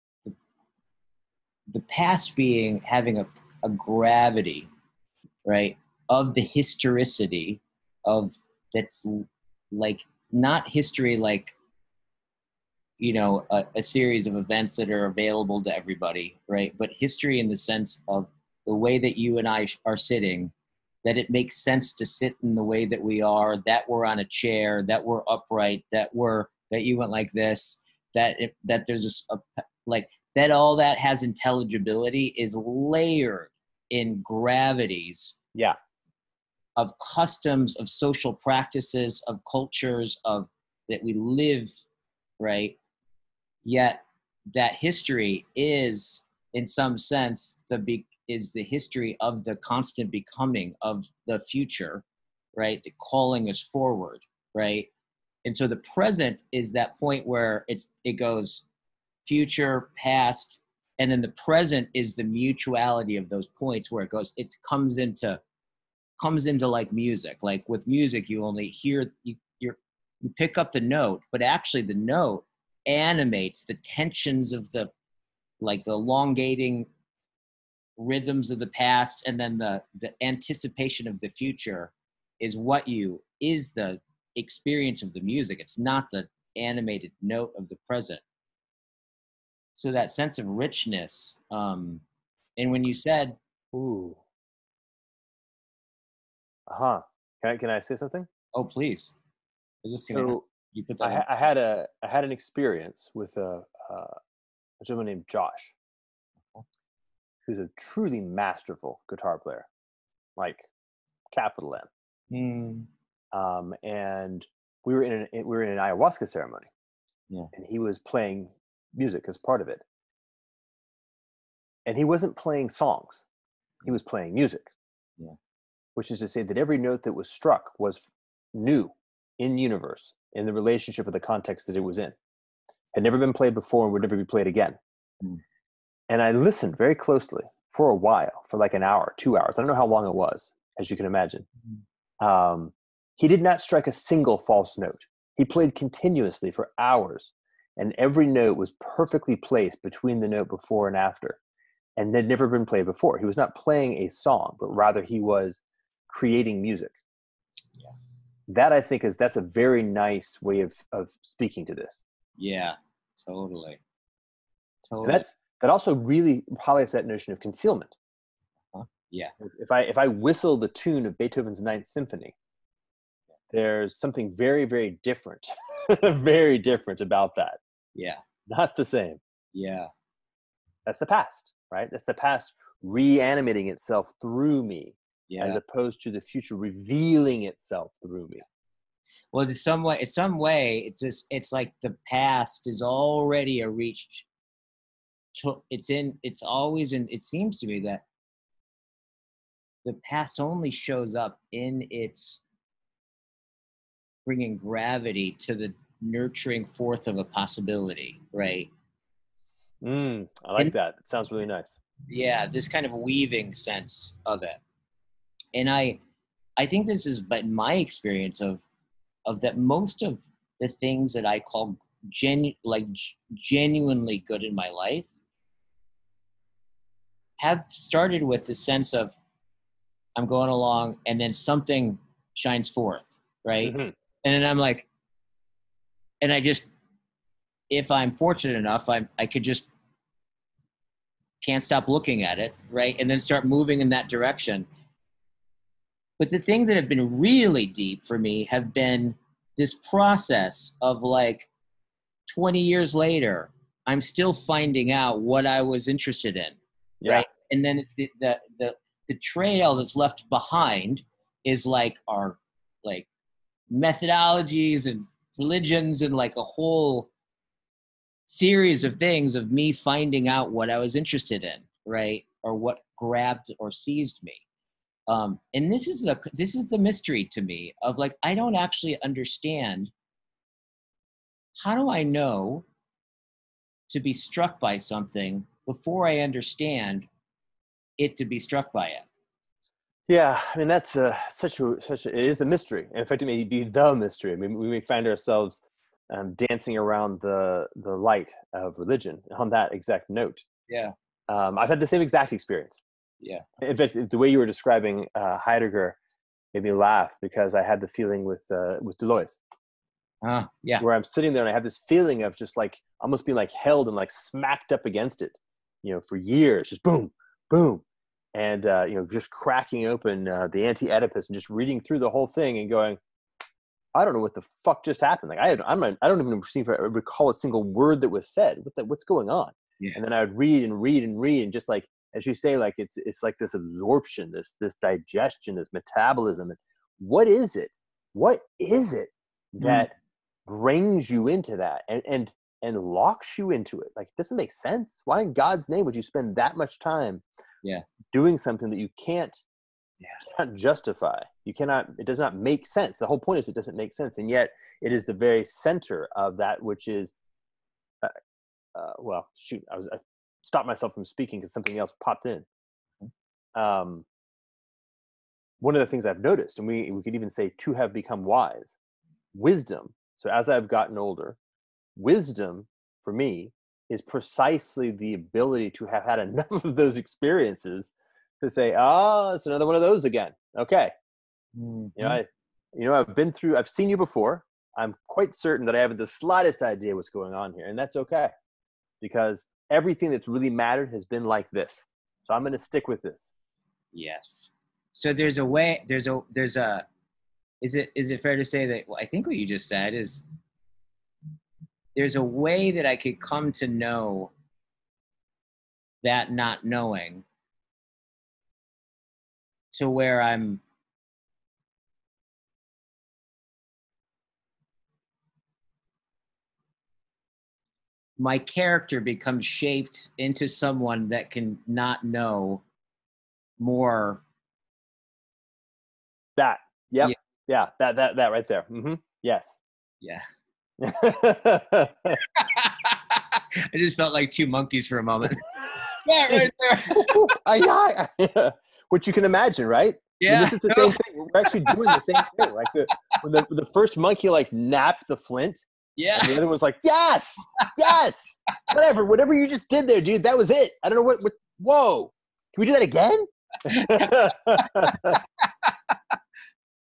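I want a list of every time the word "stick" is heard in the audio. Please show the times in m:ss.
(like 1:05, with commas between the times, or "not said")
6:32.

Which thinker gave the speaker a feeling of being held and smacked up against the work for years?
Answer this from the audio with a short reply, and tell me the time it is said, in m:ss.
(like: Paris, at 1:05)
Deleuze, at 5:08.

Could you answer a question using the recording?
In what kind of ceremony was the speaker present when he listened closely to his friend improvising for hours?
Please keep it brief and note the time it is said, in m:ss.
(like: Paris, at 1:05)
Ayahuasca ceremony, at 1:55.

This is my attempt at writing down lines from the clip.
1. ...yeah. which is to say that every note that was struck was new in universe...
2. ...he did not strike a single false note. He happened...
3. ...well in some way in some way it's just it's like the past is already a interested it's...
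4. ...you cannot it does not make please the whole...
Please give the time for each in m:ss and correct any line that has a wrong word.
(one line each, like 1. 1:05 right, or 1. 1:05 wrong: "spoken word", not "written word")
1. 2:05 right
2. 2:23 wrong: "played", not "happened"
3. 3:09 wrong: "reached", not "interested"
4. 5:51 wrong: "sense", not "please".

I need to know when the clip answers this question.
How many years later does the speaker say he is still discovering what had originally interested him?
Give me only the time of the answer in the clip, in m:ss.
4:12.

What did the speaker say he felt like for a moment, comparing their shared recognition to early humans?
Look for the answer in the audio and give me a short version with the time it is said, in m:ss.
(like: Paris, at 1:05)
Two monkeys, at 7:14.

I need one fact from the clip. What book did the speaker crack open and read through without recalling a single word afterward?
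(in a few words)
Anti-Oedipus.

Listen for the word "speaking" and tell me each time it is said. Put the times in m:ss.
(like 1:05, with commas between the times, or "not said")
2:41, 6:01.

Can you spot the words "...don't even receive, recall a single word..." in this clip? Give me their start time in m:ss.
5:26.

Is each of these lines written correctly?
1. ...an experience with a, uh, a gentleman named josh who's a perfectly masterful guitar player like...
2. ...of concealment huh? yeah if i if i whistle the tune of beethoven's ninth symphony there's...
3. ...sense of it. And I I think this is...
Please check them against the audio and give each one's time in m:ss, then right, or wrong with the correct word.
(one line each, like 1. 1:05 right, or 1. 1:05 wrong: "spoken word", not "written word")
1. 1:42 wrong: "truly", not "perfectly"
2. 2:47 right
3. 3:33 right.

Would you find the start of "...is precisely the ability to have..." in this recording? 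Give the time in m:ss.
6:13.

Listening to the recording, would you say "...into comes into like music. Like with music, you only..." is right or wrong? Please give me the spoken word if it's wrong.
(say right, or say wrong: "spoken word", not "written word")
right.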